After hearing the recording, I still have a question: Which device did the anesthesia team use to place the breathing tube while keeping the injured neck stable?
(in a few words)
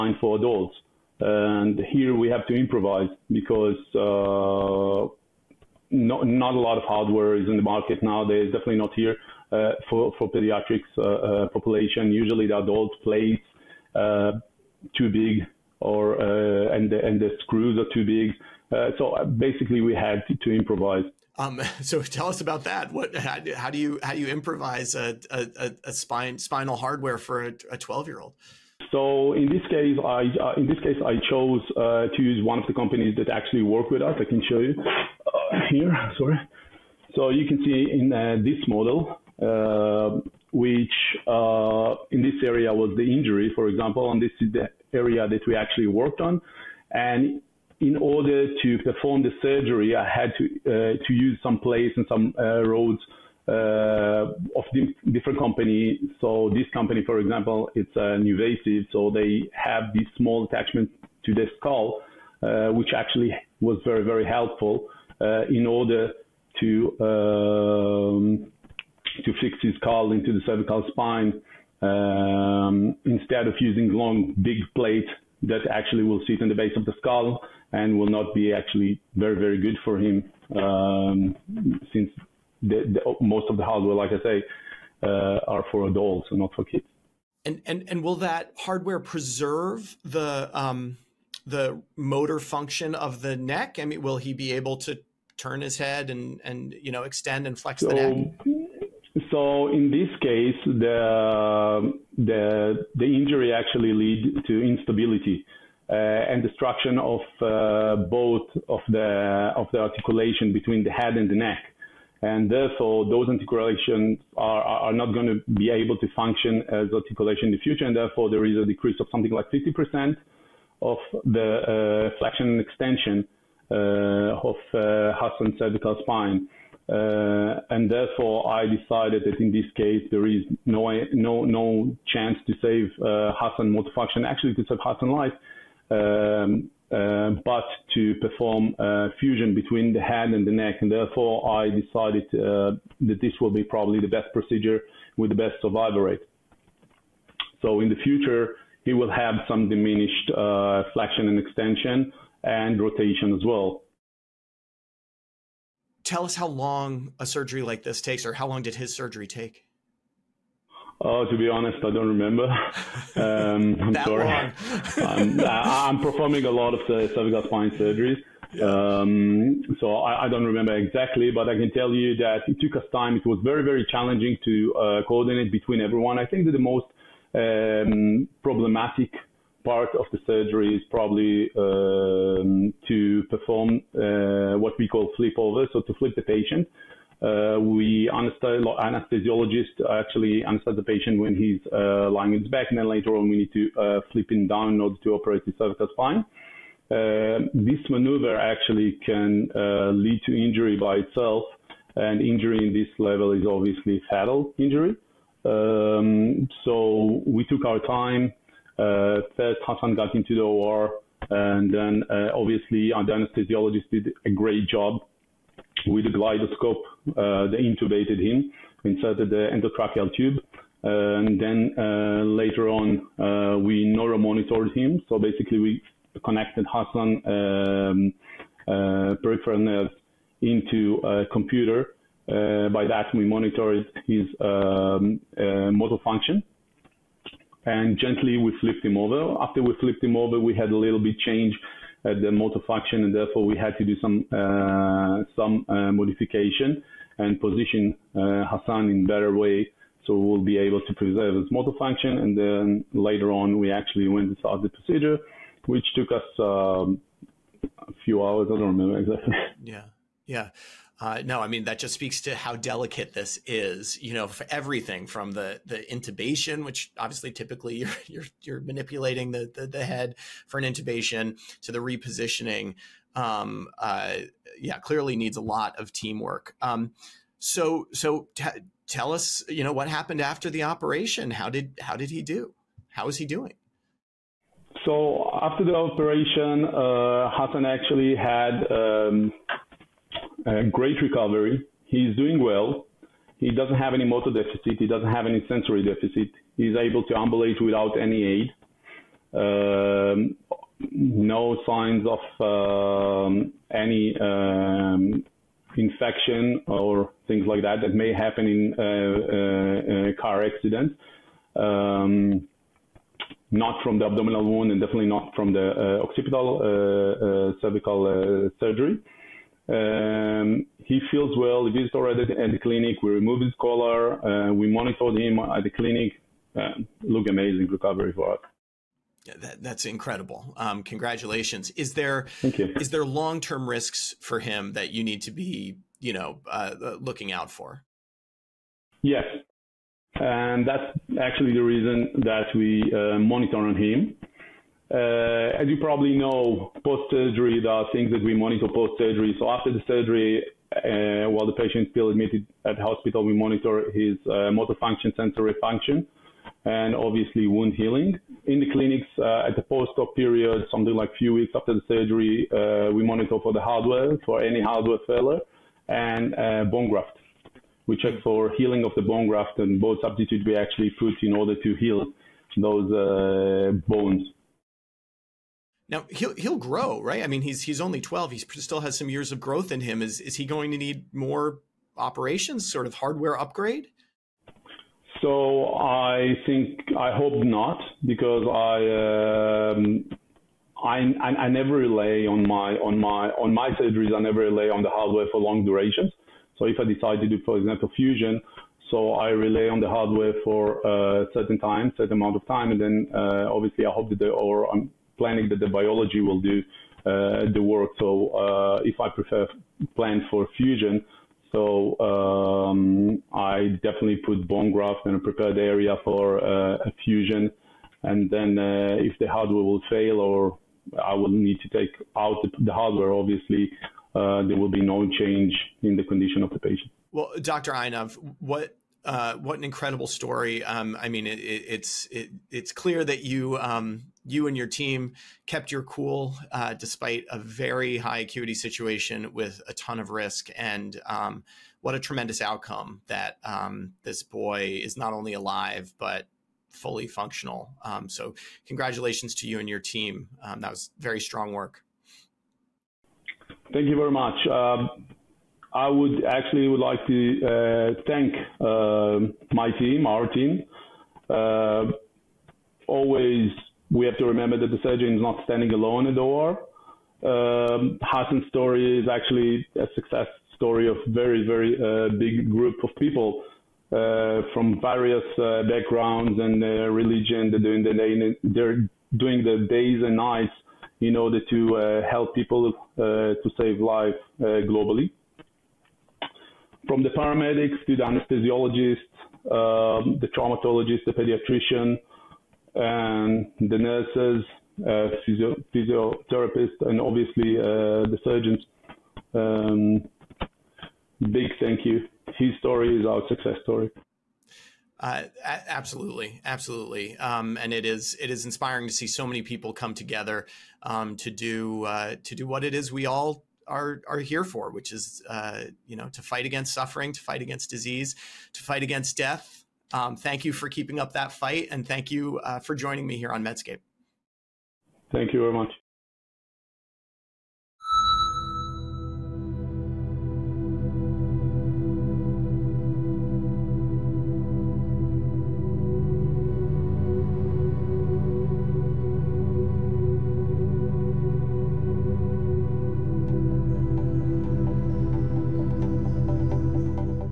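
GlideScope.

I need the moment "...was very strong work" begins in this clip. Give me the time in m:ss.
7:30.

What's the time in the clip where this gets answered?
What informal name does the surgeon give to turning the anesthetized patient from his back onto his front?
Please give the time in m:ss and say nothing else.
3:05.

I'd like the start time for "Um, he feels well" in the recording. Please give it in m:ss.
5:19.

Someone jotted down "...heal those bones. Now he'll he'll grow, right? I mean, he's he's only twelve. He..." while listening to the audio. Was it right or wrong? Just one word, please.
right.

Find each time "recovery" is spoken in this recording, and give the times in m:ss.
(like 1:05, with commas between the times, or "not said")
4:51, 5:27.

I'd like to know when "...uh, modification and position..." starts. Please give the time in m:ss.
4:05.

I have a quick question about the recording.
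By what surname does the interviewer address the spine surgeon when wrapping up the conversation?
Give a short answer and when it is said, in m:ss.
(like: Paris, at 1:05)
Einav, at 7:07.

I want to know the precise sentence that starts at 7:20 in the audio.
And um, what a tremendous outcome that um, this boy is not only alive but fully functional.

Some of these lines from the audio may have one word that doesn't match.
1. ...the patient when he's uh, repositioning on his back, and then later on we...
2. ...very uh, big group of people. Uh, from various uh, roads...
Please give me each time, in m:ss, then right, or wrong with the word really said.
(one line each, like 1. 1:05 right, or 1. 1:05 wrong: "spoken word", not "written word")
1. 3:10 wrong: "lying", not "repositioning"
2. 7:51 wrong: "backgrounds", not "roads".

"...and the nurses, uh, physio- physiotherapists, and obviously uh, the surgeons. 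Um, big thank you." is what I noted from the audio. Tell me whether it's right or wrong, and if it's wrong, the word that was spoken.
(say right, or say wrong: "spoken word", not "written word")
right.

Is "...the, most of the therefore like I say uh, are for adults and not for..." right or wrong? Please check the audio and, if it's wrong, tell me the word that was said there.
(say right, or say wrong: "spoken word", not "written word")
wrong: "hardware", not "therefore".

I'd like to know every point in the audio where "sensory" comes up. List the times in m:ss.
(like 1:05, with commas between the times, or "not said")
4:55, 5:55.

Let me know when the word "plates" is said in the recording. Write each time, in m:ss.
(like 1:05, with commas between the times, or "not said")
0:13, 1:14.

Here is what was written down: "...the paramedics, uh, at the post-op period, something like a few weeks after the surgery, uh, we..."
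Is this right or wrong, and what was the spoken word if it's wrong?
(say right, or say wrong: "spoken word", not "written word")
wrong: "clinics", not "paramedics".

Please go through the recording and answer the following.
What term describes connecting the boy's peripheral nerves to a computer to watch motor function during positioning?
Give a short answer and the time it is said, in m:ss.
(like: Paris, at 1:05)
neuromonitored, at 3:43.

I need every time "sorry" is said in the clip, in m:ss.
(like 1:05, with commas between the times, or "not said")
0:36, 2:43.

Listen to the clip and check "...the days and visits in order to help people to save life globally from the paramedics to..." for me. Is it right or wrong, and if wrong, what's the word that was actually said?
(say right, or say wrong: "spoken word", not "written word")
wrong: "nights", not "visits".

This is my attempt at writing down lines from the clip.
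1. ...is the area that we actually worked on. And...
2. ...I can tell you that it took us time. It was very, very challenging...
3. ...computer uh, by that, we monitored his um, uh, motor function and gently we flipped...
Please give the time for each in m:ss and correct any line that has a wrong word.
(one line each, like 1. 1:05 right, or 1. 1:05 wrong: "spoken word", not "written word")
1. 0:44 right
2. 2:51 right
3. 3:51 right.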